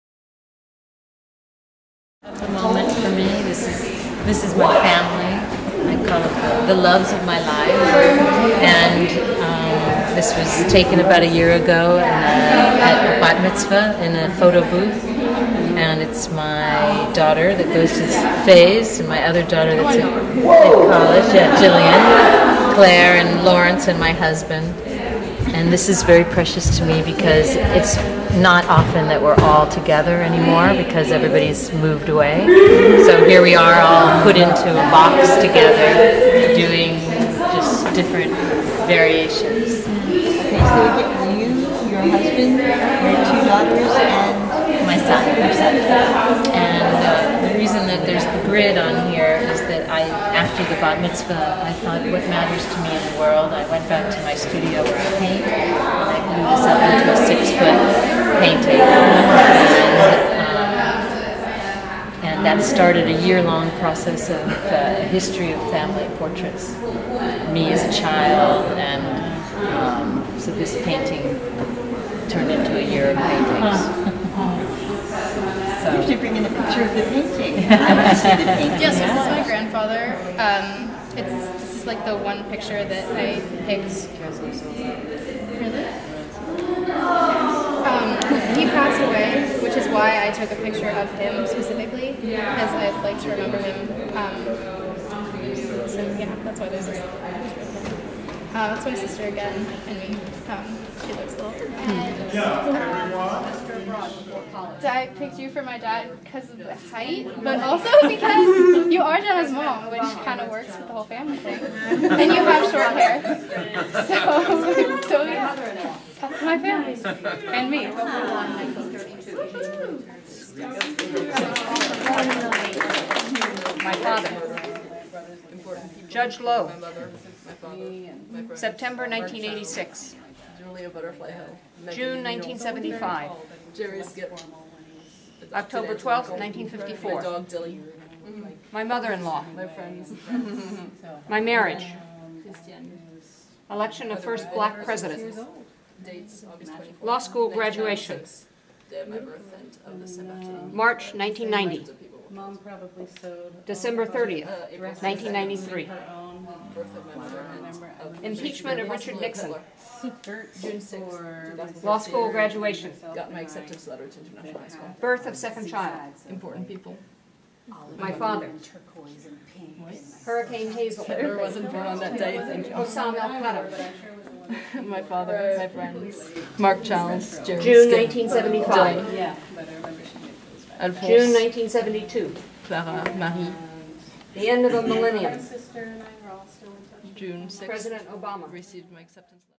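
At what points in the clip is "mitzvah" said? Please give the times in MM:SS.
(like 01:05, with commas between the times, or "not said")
00:13, 00:51.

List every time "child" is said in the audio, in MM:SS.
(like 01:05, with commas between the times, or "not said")
01:08, 02:45, 02:56.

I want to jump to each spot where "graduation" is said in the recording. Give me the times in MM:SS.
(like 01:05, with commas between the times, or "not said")
02:27, 02:42.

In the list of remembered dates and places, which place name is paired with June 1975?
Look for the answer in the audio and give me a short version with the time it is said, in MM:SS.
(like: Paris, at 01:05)
Butterfly Hill, at 02:10.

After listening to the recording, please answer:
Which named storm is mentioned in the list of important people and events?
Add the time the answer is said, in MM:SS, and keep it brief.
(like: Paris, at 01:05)
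Hurricane Hazel, at 02:50.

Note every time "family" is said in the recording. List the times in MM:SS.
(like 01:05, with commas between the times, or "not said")
00:04, 01:05, 01:51, 01:56.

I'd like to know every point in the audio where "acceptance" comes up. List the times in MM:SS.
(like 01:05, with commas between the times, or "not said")
02:43, 03:09.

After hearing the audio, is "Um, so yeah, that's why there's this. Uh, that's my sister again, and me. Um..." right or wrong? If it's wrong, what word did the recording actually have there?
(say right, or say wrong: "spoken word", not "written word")
right.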